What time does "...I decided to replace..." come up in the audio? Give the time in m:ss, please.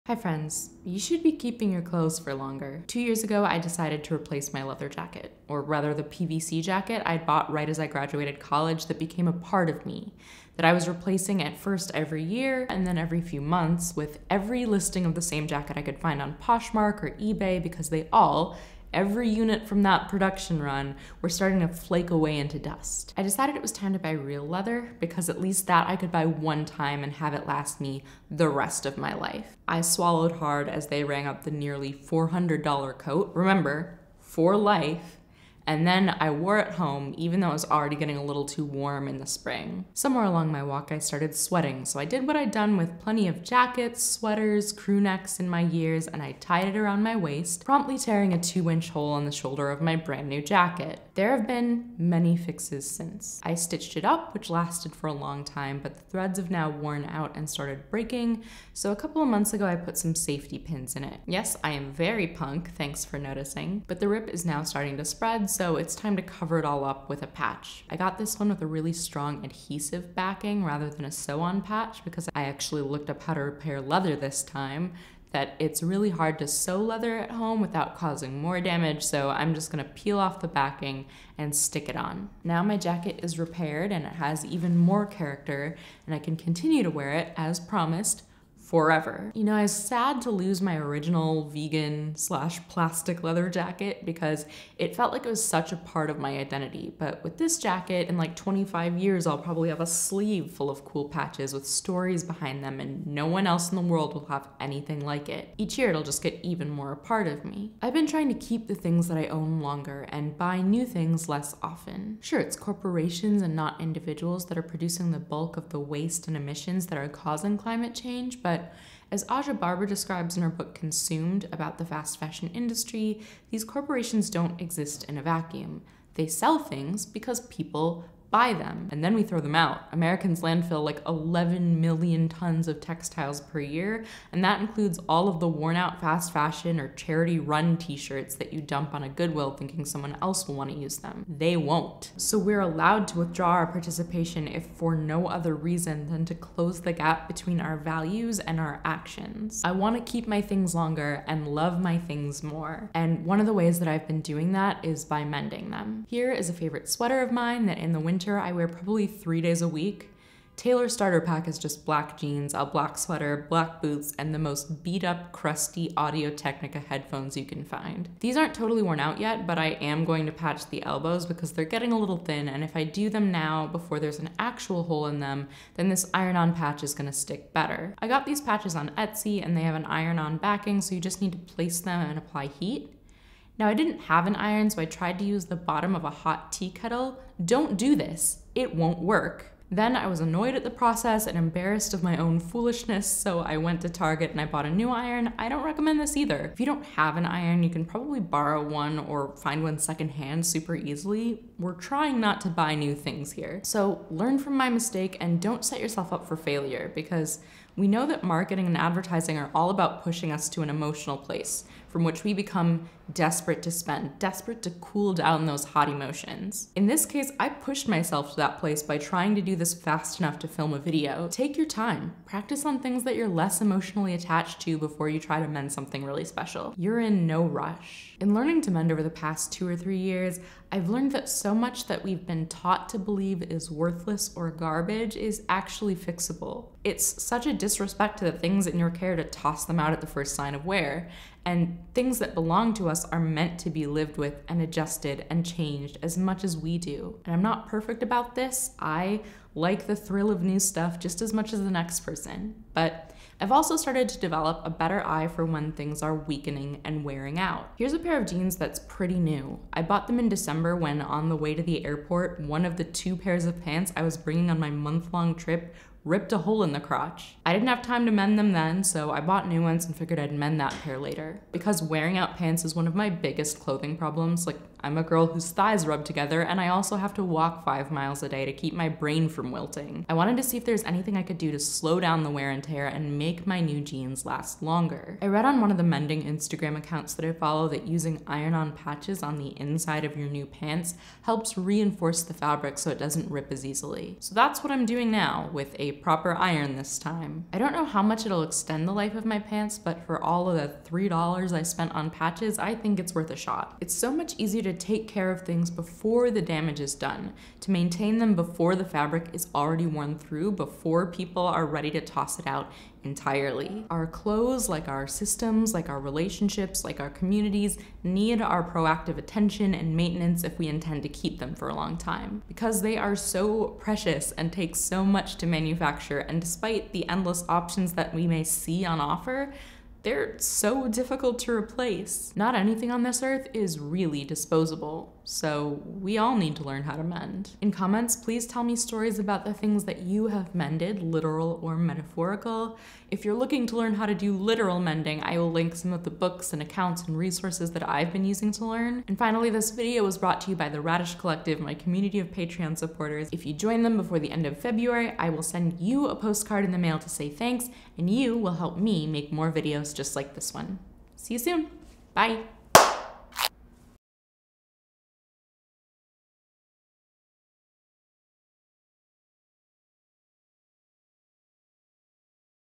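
0:03.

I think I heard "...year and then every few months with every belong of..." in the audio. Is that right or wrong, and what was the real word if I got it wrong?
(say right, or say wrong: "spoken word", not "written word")
wrong: "listing", not "belong".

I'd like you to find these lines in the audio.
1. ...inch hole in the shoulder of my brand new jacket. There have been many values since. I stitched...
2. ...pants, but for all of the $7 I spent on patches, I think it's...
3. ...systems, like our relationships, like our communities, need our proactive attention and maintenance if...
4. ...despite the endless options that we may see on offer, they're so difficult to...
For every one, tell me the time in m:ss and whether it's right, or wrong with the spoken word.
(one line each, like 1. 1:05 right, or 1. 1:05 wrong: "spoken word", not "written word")
1. 0:48 wrong: "fixes", not "values"
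2. 4:59 wrong: "3", not "7"
3. 5:15 right
4. 5:26 right.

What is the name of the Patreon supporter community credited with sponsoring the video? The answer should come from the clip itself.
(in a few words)
Radish Collective.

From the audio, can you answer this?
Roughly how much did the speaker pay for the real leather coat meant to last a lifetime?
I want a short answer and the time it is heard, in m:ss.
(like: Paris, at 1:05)
nearly $400, at 0:31.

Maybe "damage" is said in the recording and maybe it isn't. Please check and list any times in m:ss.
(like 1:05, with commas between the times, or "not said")
1:18, 5:06.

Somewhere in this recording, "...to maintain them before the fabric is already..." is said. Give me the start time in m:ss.
5:07.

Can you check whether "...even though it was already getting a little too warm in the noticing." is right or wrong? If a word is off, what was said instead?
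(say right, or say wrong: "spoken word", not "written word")
wrong: "spring", not "noticing".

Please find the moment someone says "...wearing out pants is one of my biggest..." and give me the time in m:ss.
4:31.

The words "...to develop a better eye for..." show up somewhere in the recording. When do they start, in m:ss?
4:14.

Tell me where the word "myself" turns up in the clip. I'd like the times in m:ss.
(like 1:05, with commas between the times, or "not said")
3:37.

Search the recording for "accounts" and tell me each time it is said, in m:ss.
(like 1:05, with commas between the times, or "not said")
4:46, 5:46.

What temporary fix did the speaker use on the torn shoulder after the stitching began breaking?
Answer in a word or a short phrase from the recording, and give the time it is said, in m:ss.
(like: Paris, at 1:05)
safety pins, at 1:00.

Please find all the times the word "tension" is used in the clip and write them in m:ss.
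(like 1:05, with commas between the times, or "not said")
not said.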